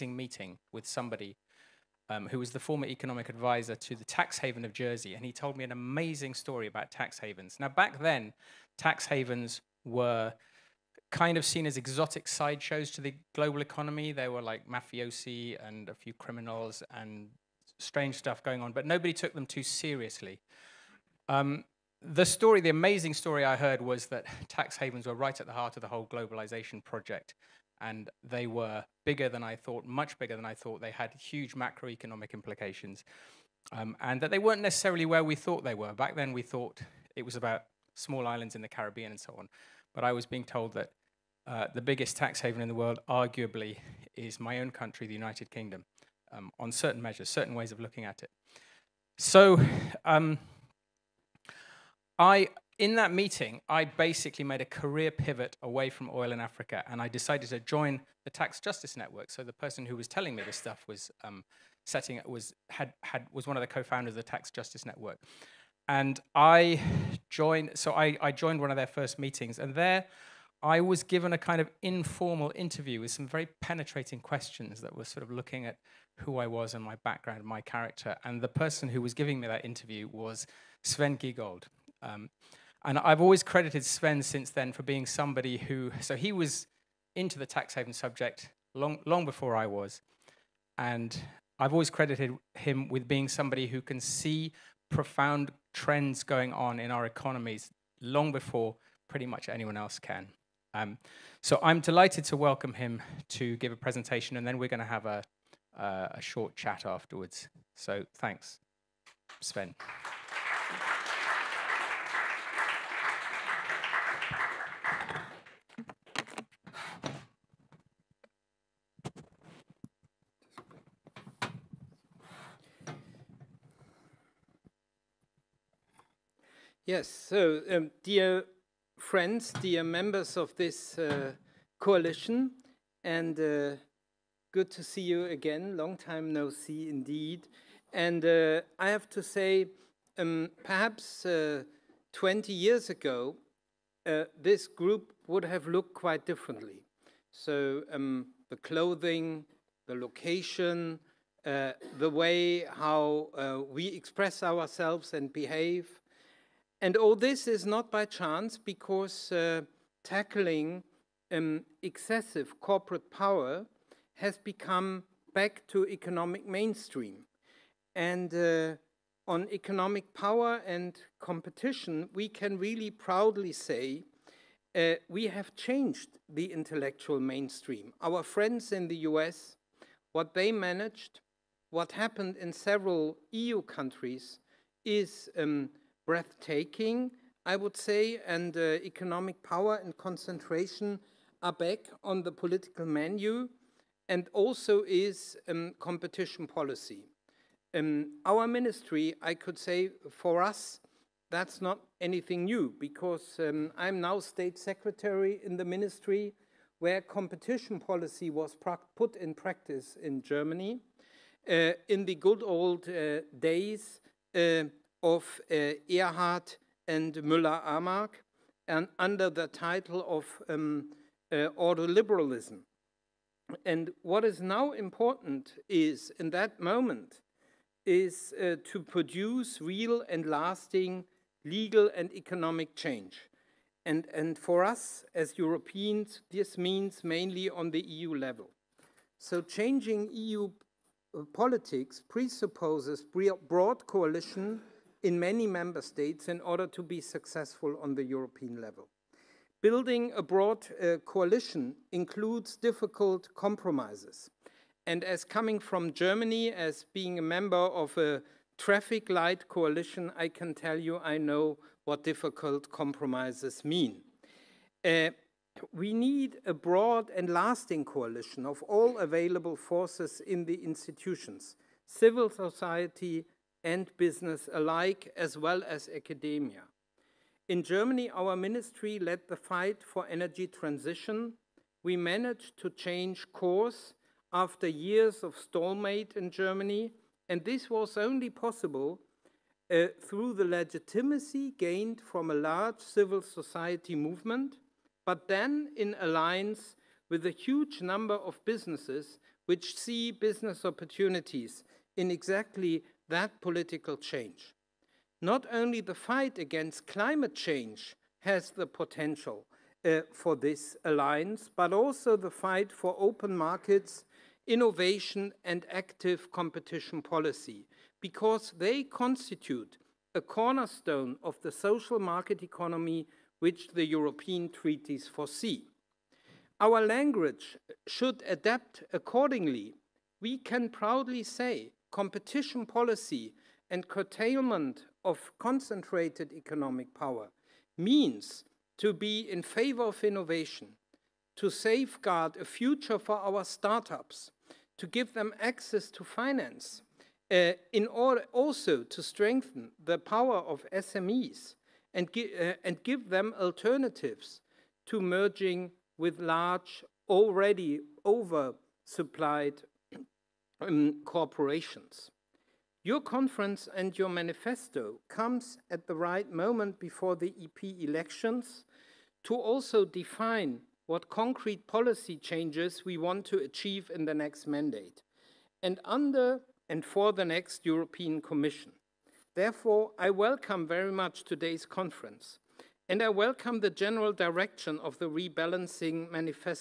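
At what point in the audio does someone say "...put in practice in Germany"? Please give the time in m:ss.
3:28.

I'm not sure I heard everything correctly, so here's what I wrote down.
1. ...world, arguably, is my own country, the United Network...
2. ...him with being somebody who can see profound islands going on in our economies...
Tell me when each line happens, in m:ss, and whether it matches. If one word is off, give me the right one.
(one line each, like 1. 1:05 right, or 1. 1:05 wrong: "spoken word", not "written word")
1. 0:42 wrong: "Kingdom", not "Network"
2. 1:32 wrong: "trends", not "islands".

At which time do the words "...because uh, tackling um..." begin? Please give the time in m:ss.
2:38.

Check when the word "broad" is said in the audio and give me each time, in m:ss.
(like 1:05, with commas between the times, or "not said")
4:03, 4:10, 4:26.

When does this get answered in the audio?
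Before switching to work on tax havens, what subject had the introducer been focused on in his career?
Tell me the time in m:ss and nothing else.
0:56.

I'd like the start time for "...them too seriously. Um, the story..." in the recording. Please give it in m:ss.
0:19.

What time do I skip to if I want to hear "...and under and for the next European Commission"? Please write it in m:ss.
6:15.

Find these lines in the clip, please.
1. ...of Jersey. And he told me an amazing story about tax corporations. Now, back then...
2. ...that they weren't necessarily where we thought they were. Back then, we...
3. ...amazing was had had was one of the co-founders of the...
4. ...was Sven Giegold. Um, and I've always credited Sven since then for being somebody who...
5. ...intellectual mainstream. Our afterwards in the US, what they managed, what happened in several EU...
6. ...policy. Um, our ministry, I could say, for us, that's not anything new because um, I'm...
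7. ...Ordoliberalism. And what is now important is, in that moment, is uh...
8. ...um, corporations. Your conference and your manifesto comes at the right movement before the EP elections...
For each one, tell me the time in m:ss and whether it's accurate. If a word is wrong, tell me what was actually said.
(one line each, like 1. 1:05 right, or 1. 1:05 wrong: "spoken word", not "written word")
1. 0:04 wrong: "havens", not "corporations"
2. 0:34 right
3. 1:01 wrong: "setting", not "amazing"
4. 1:20 right
5. 2:56 wrong: "friends", not "afterwards"
6. 3:16 right
7. 3:41 right
8. 6:00 wrong: "moment", not "movement".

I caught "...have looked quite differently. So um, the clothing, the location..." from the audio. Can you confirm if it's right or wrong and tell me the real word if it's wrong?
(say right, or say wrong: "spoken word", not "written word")
right.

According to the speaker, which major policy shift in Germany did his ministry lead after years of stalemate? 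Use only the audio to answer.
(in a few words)
energy transition.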